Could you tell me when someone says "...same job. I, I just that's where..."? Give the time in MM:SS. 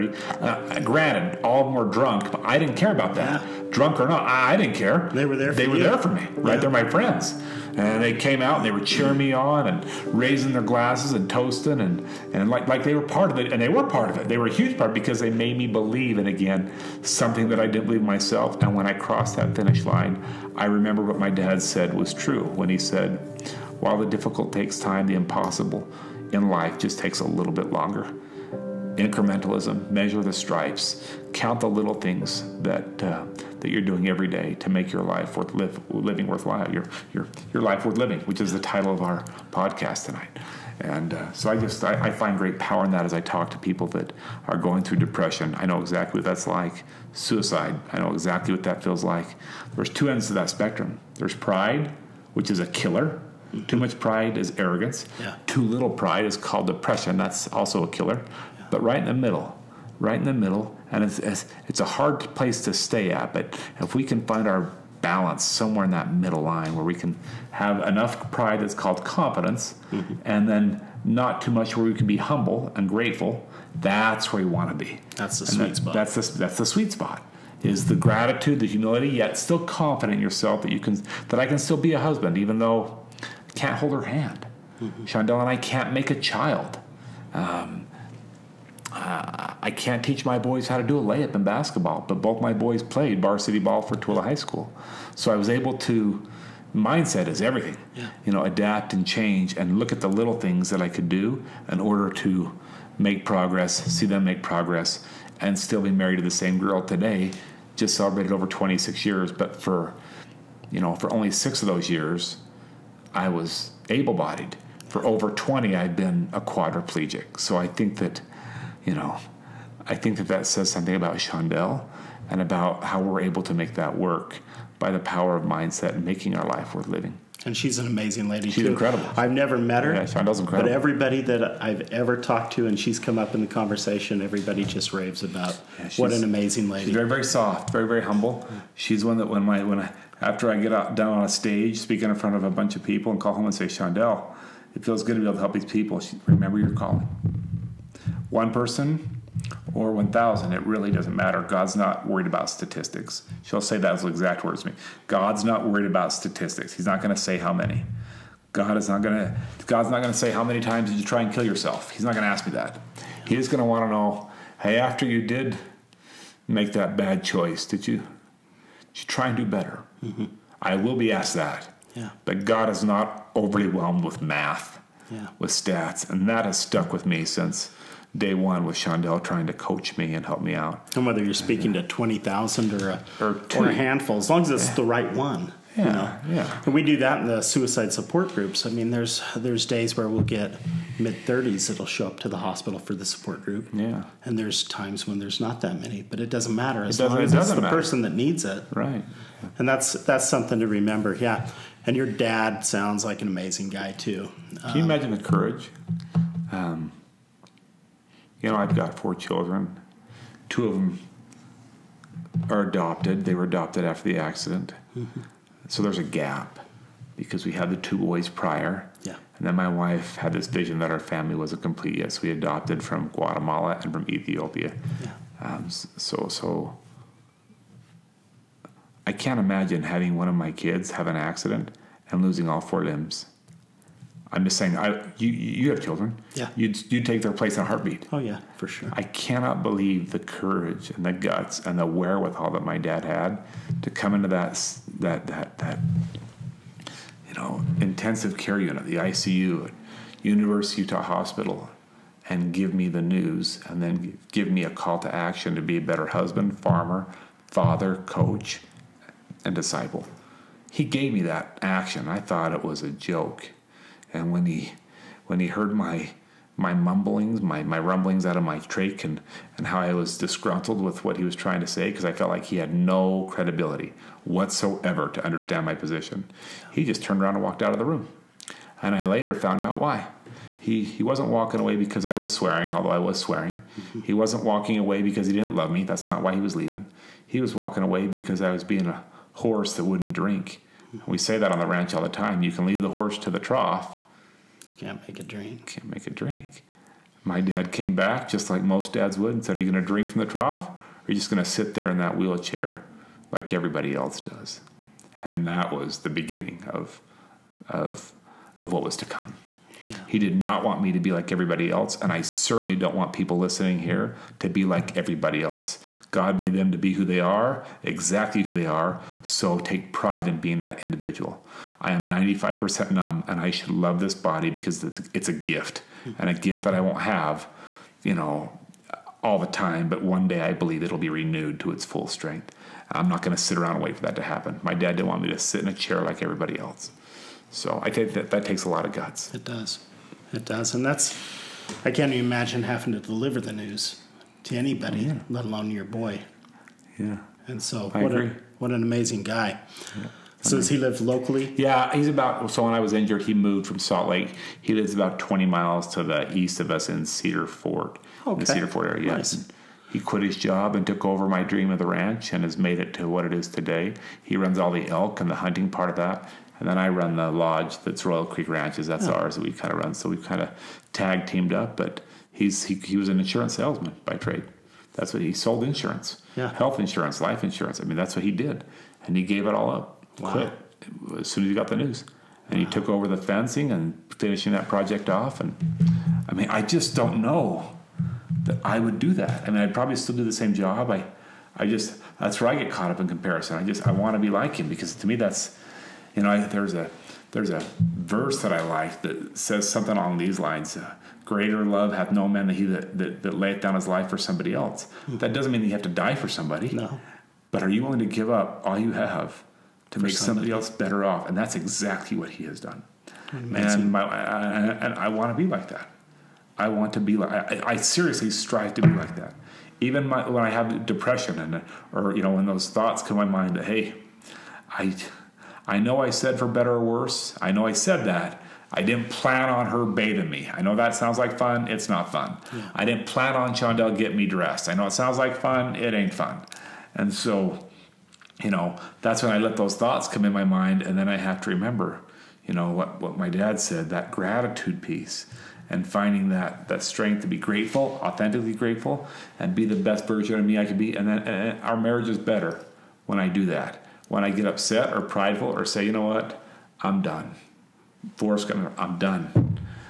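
06:30.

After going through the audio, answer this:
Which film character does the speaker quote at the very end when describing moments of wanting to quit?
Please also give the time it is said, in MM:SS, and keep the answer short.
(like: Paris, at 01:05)
Forrest Gump, at 07:38.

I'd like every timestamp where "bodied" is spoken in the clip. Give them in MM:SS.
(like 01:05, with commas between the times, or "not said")
01:54.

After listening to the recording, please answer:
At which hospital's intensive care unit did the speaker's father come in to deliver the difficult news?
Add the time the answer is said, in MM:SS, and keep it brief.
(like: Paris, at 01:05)
University Utah Hospital, at 04:10.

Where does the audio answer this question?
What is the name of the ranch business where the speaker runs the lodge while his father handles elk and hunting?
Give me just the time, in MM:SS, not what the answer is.
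06:08.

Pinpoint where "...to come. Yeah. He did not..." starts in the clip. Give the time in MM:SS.
05:08.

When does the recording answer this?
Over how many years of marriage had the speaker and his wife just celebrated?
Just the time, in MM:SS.
01:48.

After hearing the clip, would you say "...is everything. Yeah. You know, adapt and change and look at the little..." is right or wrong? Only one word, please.
right.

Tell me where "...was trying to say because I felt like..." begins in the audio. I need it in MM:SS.
04:31.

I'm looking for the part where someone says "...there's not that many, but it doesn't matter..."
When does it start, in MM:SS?
03:15.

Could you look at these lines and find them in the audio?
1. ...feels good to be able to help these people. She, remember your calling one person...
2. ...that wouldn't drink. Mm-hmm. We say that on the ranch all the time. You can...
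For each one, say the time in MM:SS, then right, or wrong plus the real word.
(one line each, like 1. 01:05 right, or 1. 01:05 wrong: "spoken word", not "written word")
1. 02:24 right
2. 04:49 right.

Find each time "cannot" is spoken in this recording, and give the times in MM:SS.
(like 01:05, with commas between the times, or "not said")
03:59.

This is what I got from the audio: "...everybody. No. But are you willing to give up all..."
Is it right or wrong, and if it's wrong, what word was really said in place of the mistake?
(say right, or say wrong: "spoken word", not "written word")
wrong: "somebody", not "everybody".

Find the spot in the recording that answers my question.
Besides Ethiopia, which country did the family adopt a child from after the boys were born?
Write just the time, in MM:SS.
03:43.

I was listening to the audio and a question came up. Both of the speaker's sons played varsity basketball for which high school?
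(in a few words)
Tooele High School.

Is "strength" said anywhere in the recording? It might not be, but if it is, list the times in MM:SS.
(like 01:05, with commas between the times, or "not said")
05:32, 07:26.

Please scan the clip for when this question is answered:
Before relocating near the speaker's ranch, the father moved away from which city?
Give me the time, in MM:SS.
05:53.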